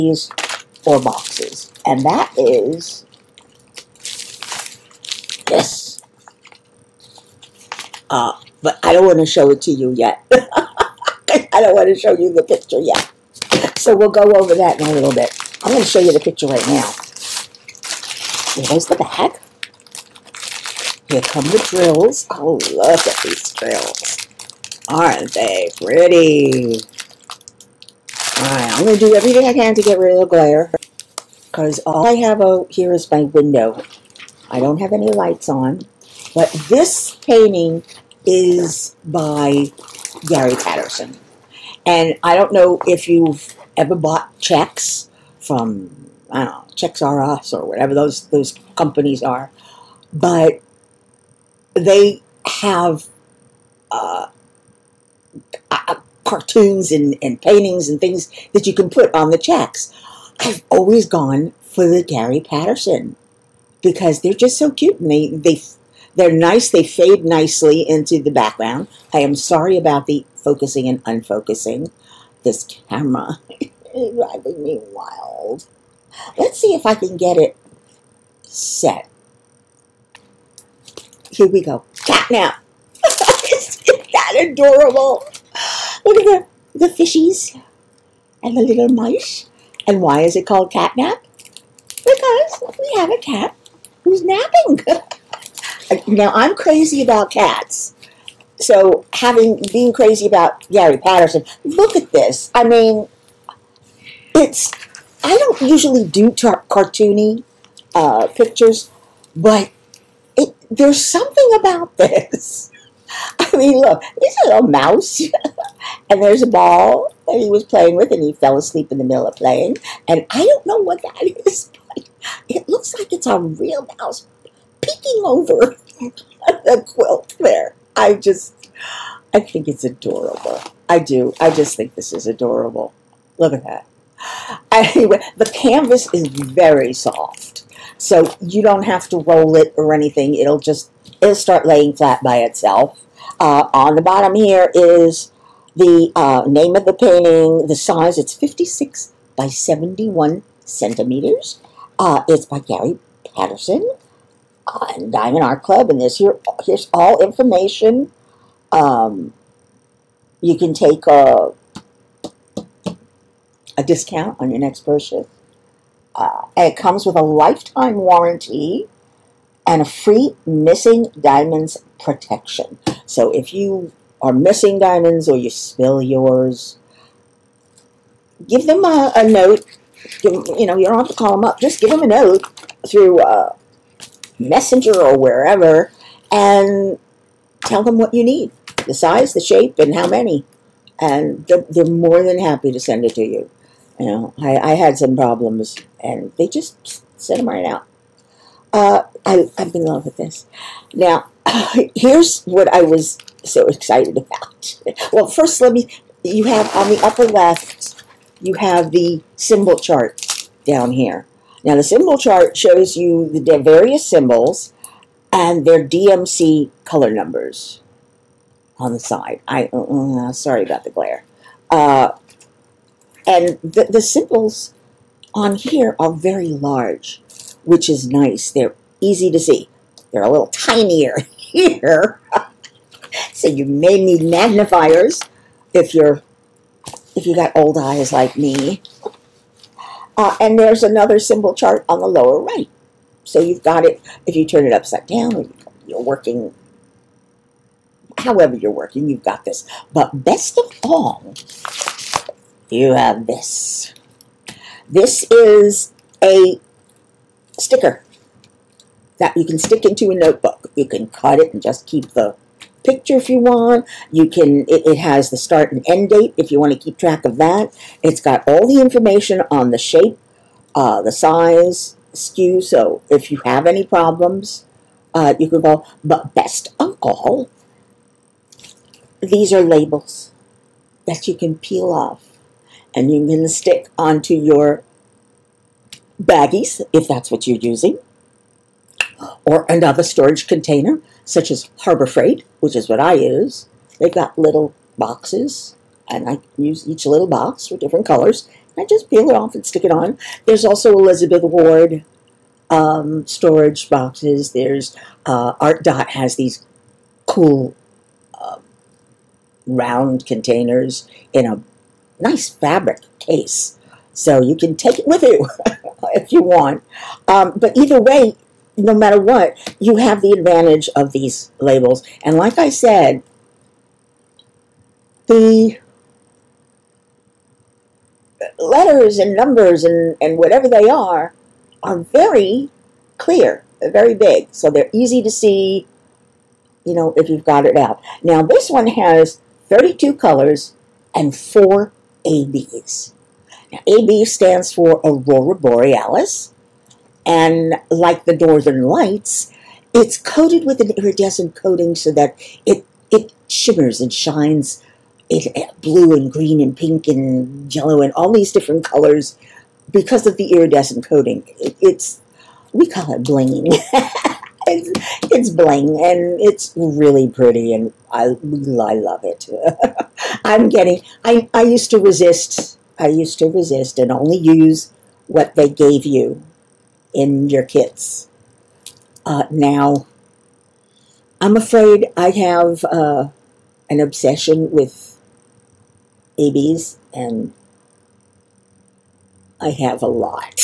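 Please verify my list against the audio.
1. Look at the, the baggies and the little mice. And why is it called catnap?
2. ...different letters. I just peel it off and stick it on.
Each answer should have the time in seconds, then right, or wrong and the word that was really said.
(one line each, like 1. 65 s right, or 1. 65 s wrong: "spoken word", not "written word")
1. 86 s wrong: "fishies", not "baggies"
2. 297 s wrong: "colors", not "letters".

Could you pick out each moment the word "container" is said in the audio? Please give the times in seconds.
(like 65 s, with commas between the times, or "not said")
290 s, 310 s.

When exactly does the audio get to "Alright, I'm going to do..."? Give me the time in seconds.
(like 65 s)
28 s.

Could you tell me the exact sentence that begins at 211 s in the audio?
Now, the symbol chart shows you the various symbols and their DMC color numbers on the side.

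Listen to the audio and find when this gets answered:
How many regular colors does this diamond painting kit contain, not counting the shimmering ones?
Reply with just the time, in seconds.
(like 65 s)
339 s.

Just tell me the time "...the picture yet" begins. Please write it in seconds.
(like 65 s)
12 s.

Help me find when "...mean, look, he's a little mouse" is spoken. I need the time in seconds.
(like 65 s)
113 s.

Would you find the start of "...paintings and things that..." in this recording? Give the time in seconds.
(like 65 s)
57 s.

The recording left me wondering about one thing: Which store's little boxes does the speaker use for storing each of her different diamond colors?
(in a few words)
Harbor Freight.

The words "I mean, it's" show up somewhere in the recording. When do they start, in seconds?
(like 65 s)
102 s.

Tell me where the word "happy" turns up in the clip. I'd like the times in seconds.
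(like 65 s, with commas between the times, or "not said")
192 s.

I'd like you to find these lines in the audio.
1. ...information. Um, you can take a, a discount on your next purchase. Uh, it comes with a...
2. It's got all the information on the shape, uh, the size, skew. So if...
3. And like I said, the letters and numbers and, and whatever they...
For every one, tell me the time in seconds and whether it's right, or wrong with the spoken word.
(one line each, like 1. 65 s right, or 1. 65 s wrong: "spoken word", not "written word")
1. 157 s right
2. 268 s right
3. 322 s right.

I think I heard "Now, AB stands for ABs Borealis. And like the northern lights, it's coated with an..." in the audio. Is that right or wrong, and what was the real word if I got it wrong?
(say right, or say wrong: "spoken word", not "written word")
wrong: "Aurora", not "ABs".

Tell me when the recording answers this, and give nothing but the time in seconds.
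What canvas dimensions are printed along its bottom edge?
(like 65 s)
148 s.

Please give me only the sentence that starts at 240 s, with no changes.
Uh, and there's another symbol chart on the lower right.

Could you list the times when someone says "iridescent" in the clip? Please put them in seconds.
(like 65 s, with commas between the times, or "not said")
350 s, 360 s.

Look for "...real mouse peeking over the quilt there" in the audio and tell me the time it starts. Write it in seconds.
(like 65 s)
123 s.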